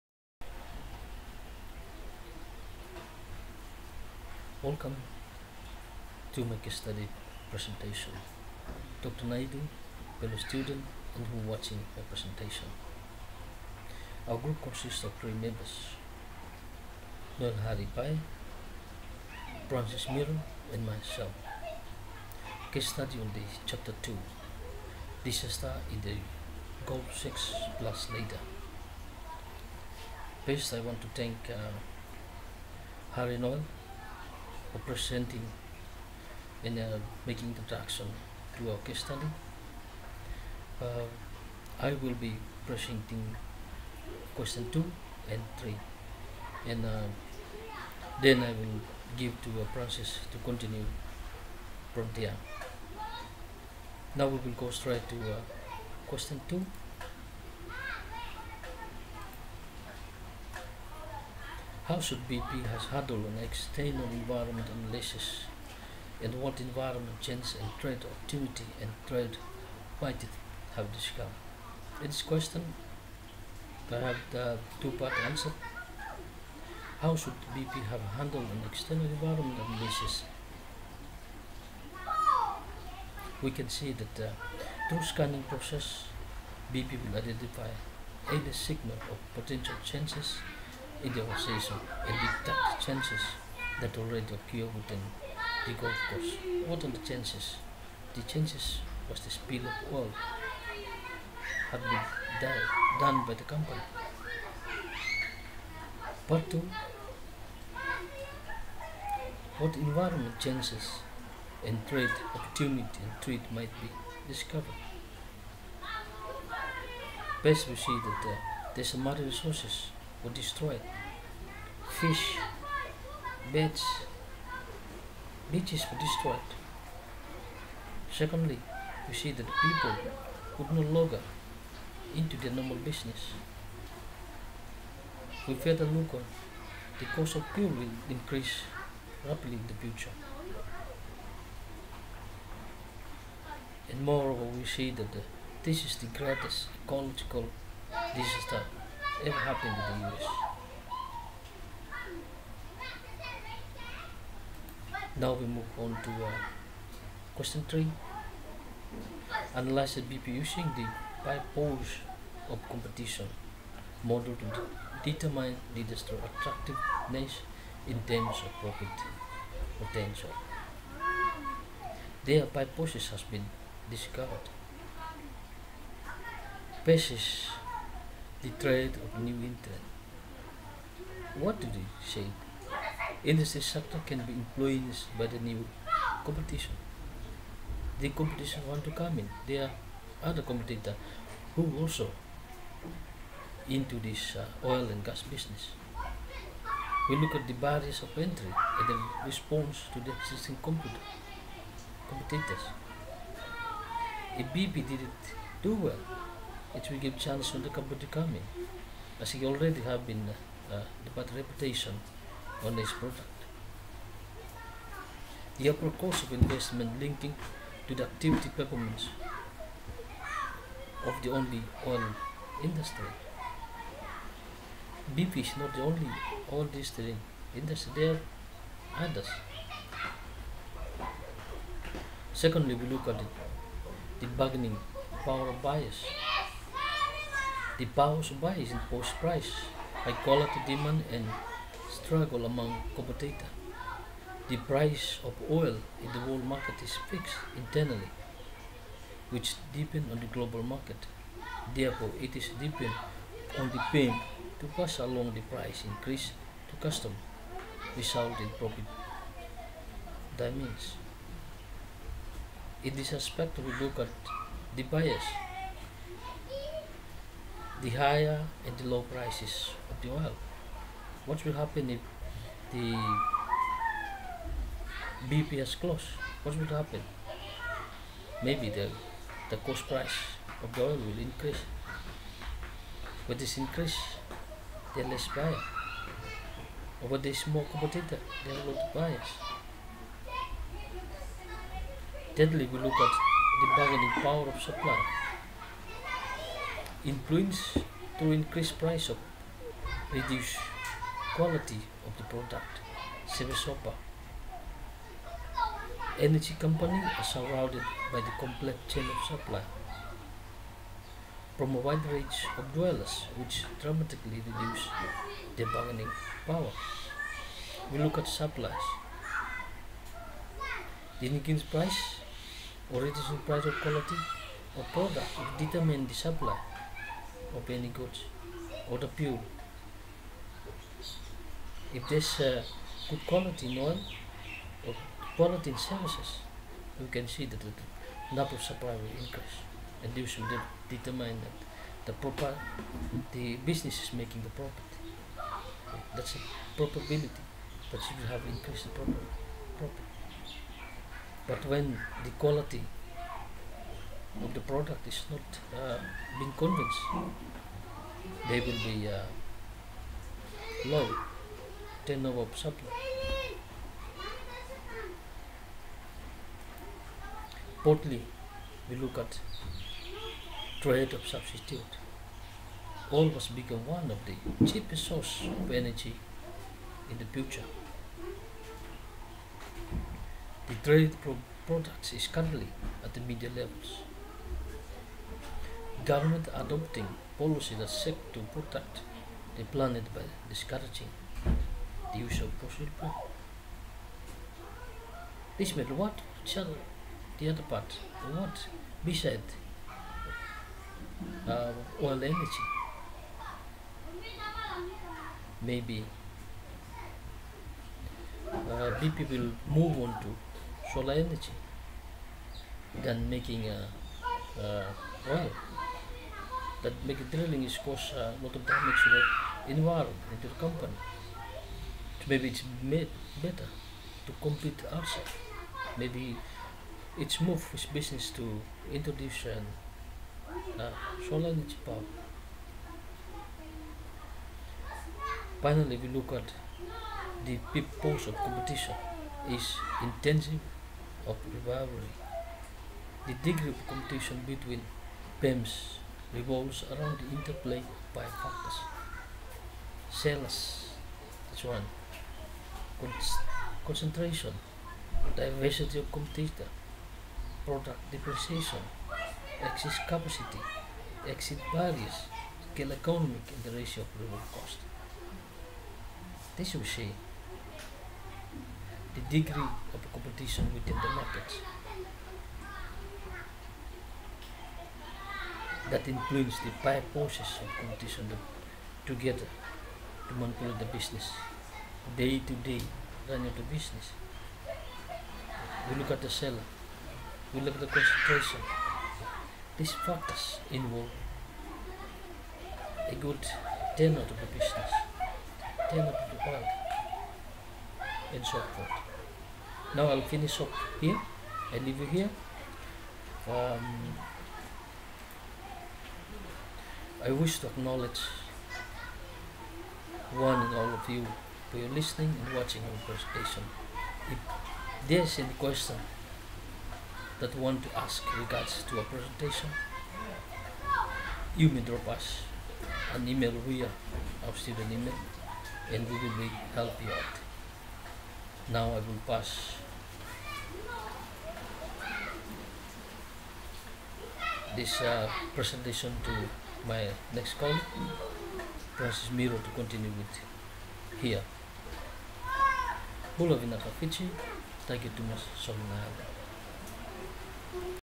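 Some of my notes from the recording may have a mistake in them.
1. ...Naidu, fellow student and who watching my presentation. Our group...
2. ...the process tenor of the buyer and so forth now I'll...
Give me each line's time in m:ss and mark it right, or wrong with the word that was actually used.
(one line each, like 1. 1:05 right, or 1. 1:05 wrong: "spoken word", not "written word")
1. 0:09 right
2. 8:14 wrong: "business", not "process".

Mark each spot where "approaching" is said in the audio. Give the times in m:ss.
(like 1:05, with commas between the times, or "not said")
not said.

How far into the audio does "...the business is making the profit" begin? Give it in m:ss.
5:43.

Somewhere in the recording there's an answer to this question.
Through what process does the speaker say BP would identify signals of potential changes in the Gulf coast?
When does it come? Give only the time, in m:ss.
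1:25.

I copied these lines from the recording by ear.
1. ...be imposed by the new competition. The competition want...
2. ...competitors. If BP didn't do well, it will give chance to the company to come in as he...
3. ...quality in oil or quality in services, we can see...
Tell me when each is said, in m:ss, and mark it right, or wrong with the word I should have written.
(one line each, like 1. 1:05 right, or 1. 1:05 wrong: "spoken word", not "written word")
1. 3:04 wrong: "influenced", not "imposed"
2. 3:22 right
3. 5:33 right.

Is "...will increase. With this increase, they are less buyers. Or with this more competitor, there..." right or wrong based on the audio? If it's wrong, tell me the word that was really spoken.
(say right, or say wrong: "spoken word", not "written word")
right.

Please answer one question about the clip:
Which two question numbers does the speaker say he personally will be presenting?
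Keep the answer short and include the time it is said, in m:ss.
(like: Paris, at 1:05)
2 and 3, at 0:44.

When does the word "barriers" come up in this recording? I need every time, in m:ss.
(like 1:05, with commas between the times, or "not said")
3:17, 7:41.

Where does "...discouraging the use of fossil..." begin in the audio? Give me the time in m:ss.
6:30.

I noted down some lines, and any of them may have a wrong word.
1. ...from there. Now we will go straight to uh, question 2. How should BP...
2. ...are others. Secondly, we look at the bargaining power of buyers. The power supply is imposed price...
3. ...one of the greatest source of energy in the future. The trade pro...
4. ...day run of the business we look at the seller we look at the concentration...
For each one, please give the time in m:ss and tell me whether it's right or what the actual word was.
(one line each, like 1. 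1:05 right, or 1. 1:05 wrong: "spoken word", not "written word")
1. 0:51 right
2. 3:48 right
3. 6:13 wrong: "cheapest", not "greatest"
4. 8:02 right.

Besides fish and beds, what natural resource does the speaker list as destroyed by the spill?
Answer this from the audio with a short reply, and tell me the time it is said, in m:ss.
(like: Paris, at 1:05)
Beaches, at 2:05.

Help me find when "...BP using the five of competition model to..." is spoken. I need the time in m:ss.
2:40.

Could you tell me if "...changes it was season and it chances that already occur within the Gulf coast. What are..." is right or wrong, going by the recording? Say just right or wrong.
right.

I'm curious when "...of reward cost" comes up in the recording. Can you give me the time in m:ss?
7:44.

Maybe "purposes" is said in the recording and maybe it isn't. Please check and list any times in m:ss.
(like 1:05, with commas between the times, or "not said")
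2:52, 7:17.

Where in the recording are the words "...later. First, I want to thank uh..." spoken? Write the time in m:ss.
0:28.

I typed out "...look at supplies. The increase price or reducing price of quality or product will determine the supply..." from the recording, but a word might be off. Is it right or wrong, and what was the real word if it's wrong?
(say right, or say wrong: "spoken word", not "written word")
right.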